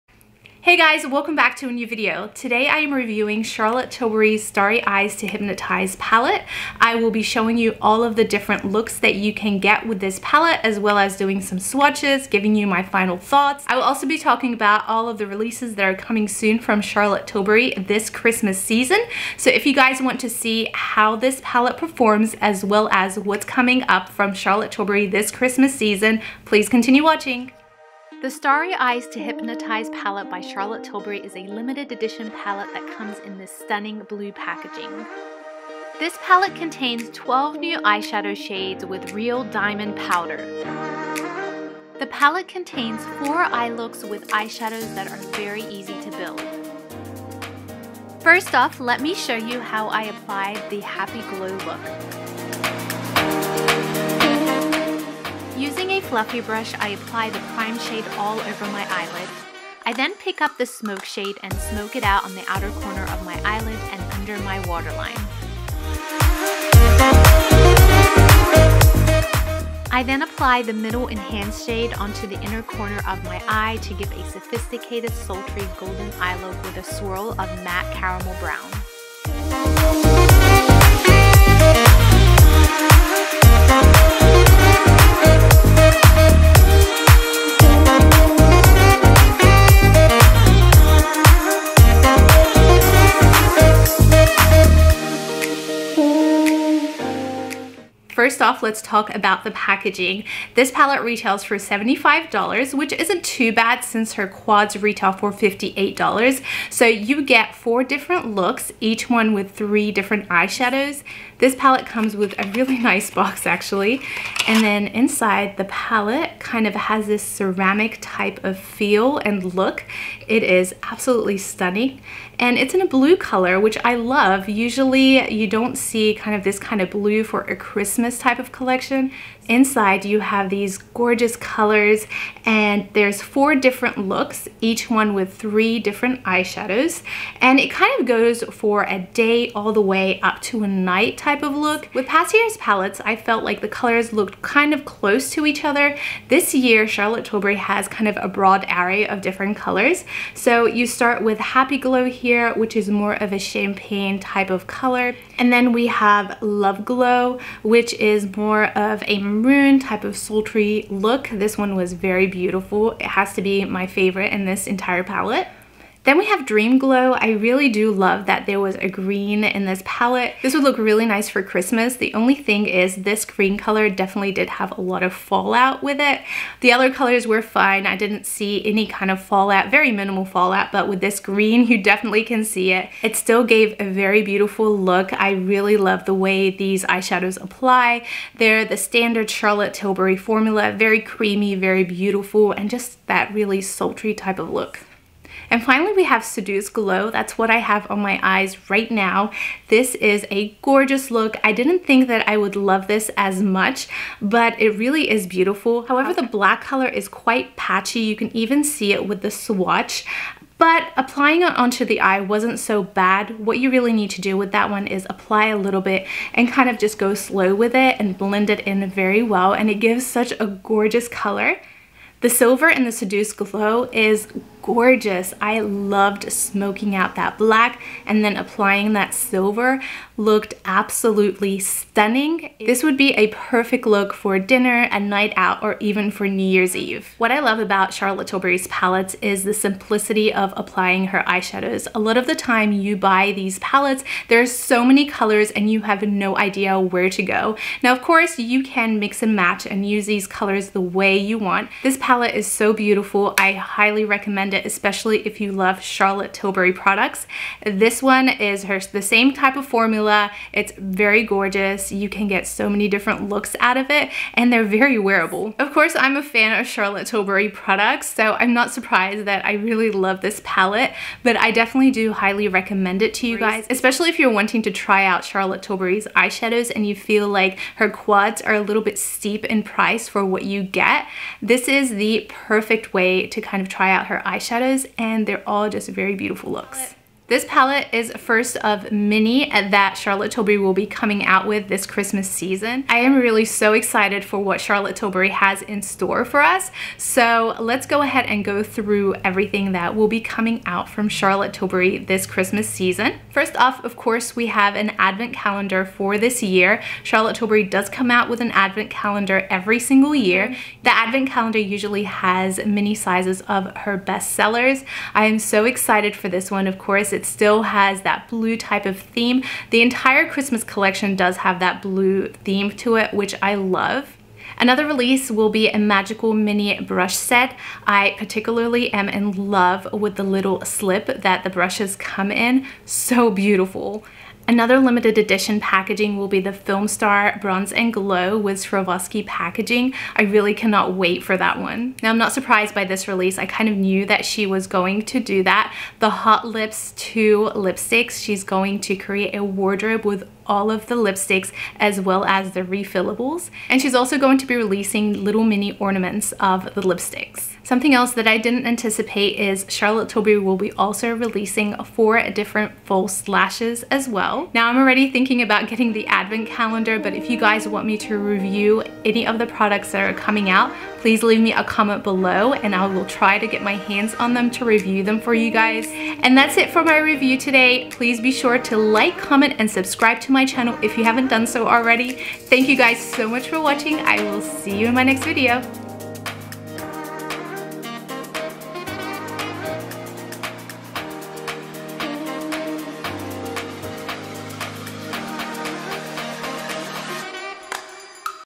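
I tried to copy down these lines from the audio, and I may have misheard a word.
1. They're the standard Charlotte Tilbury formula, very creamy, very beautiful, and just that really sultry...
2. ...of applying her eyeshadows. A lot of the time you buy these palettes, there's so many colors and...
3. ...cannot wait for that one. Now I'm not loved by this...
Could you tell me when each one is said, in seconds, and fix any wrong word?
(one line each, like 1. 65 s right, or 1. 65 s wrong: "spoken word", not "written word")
1. 188 s right
2. 240 s right
3. 340 s wrong: "surprised", not "loved".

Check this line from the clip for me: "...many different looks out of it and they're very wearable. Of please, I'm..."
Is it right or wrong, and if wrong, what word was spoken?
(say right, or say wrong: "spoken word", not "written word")
wrong: "course", not "please".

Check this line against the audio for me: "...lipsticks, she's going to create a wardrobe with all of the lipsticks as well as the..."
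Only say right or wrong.
right.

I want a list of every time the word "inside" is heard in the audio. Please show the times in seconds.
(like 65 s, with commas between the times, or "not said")
114 s, 129 s.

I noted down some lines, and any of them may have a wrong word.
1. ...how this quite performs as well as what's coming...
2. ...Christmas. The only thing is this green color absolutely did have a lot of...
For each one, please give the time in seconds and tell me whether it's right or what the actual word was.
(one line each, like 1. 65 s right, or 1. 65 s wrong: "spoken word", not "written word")
1. 20 s wrong: "palette", not "quite"
2. 171 s wrong: "definitely", not "absolutely".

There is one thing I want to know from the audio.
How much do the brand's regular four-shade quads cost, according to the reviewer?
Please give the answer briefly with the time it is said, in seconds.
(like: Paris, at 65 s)
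$58, at 105 s.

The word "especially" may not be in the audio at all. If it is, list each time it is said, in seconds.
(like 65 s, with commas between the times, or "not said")
254 s, 273 s.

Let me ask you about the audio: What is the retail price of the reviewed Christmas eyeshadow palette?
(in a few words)
$75.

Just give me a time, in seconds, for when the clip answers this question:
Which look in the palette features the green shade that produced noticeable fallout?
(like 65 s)
166 s.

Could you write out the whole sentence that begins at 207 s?
You can even see it with the swatch but applying it onto the eye wasn't so bad.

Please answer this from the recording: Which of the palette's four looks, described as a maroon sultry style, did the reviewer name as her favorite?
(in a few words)
Love Glow.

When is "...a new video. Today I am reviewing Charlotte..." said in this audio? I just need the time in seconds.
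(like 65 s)
1 s.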